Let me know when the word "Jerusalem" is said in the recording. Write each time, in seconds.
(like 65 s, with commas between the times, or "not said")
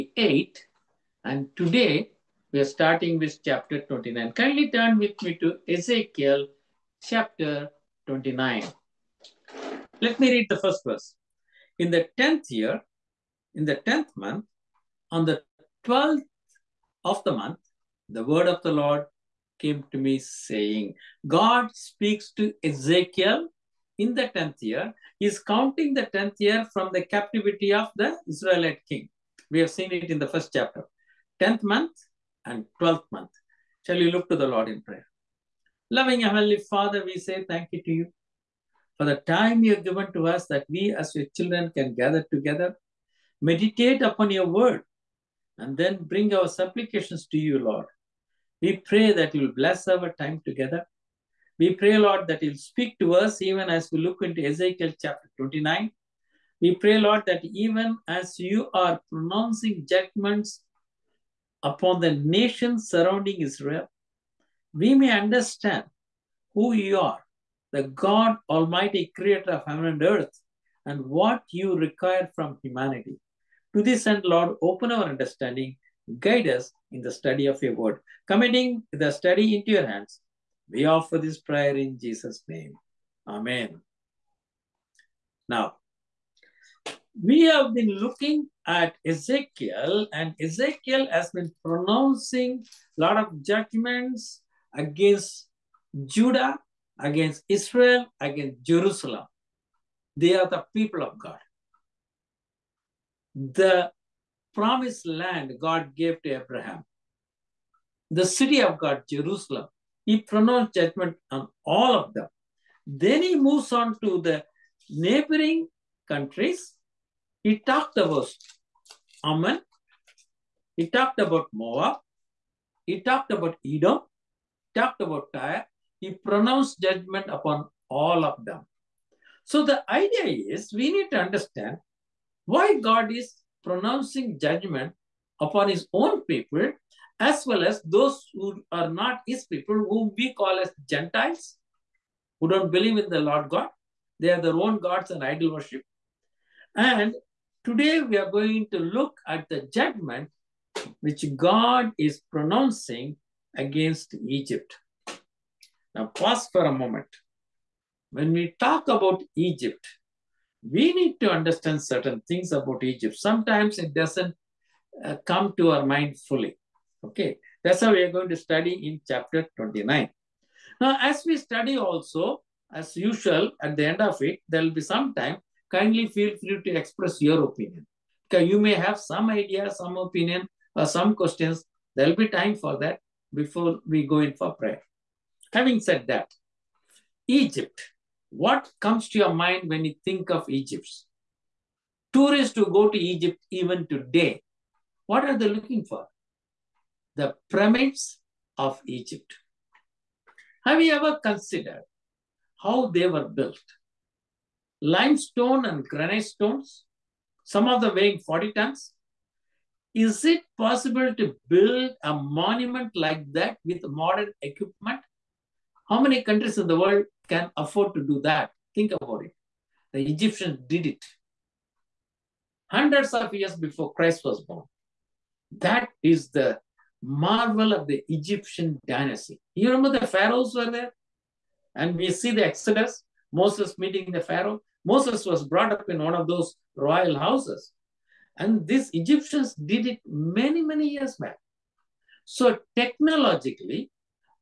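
98 s, 109 s.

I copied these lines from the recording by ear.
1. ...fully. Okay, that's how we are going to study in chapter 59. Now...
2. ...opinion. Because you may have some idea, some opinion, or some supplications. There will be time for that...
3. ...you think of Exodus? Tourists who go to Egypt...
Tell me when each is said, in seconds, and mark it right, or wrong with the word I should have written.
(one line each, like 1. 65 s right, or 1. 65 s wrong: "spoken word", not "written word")
1. 166 s wrong: "29", not "59"
2. 177 s wrong: "questions", not "supplications"
3. 189 s wrong: "Egypt", not "Exodus".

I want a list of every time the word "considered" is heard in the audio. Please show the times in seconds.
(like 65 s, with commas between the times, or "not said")
201 s.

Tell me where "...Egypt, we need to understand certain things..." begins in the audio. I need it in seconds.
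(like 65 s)
159 s.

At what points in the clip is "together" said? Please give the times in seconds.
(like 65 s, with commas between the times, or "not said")
42 s, 50 s.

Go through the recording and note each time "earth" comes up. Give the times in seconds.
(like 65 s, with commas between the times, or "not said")
70 s.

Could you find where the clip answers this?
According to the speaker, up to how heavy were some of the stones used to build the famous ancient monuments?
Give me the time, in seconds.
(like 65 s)
208 s.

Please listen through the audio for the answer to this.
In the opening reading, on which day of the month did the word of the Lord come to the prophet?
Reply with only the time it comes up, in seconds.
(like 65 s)
15 s.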